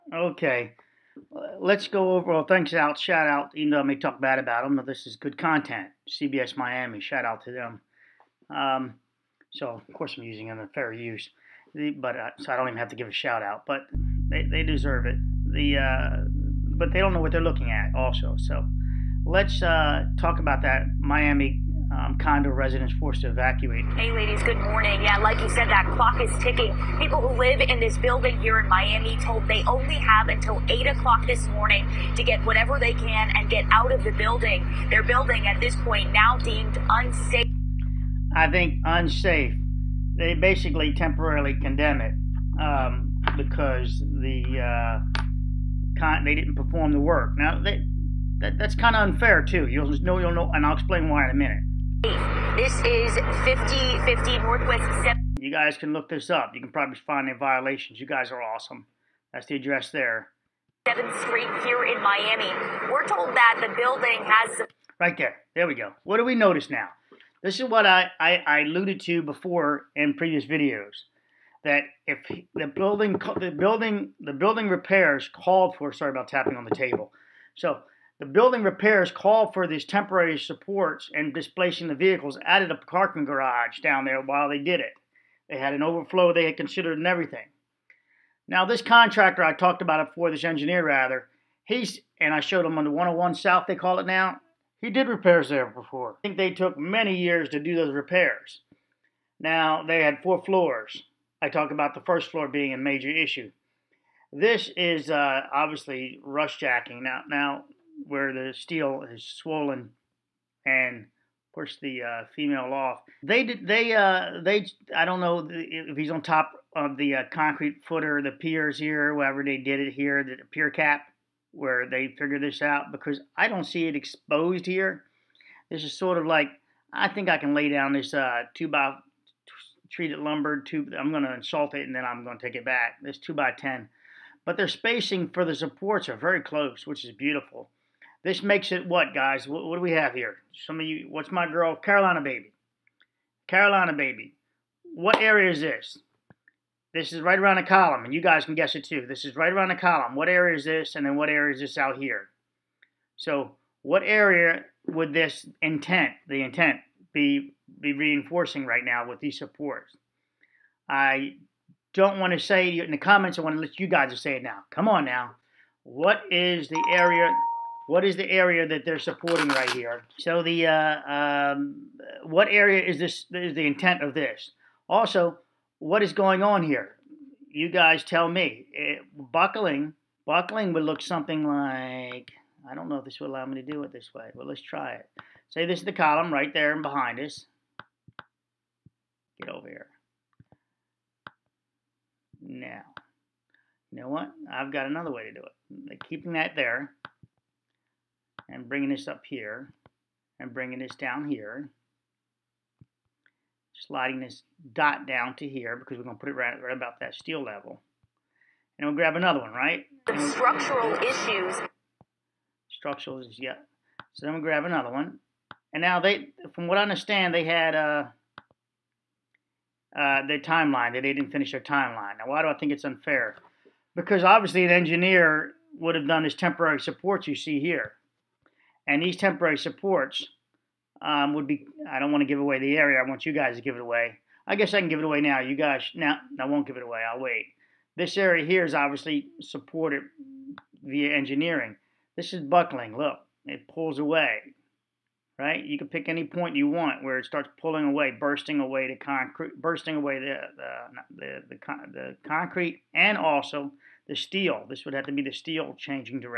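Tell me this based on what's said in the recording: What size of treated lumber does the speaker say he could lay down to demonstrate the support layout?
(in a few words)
Two by ten.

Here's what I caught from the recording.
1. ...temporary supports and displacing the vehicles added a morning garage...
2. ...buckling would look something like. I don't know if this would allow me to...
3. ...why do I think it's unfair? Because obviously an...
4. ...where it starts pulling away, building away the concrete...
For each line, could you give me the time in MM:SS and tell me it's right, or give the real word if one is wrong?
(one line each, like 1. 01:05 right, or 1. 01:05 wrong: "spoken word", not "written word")
1. 01:19 wrong: "parking", not "morning"
2. 03:00 right
3. 03:42 right
4. 04:07 wrong: "bursting", not "building".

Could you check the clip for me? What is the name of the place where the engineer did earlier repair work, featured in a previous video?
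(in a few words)
101 South.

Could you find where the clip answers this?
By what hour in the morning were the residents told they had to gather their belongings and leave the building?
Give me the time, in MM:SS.
00:30.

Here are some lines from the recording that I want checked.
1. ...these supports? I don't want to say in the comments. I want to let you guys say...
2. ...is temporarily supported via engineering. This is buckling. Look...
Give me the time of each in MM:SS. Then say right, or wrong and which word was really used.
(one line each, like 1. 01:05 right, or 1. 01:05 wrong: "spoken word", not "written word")
1. 02:39 right
2. 03:58 wrong: "obviously", not "temporarily".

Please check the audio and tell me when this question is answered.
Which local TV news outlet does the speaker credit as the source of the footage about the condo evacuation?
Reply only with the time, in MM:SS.
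00:06.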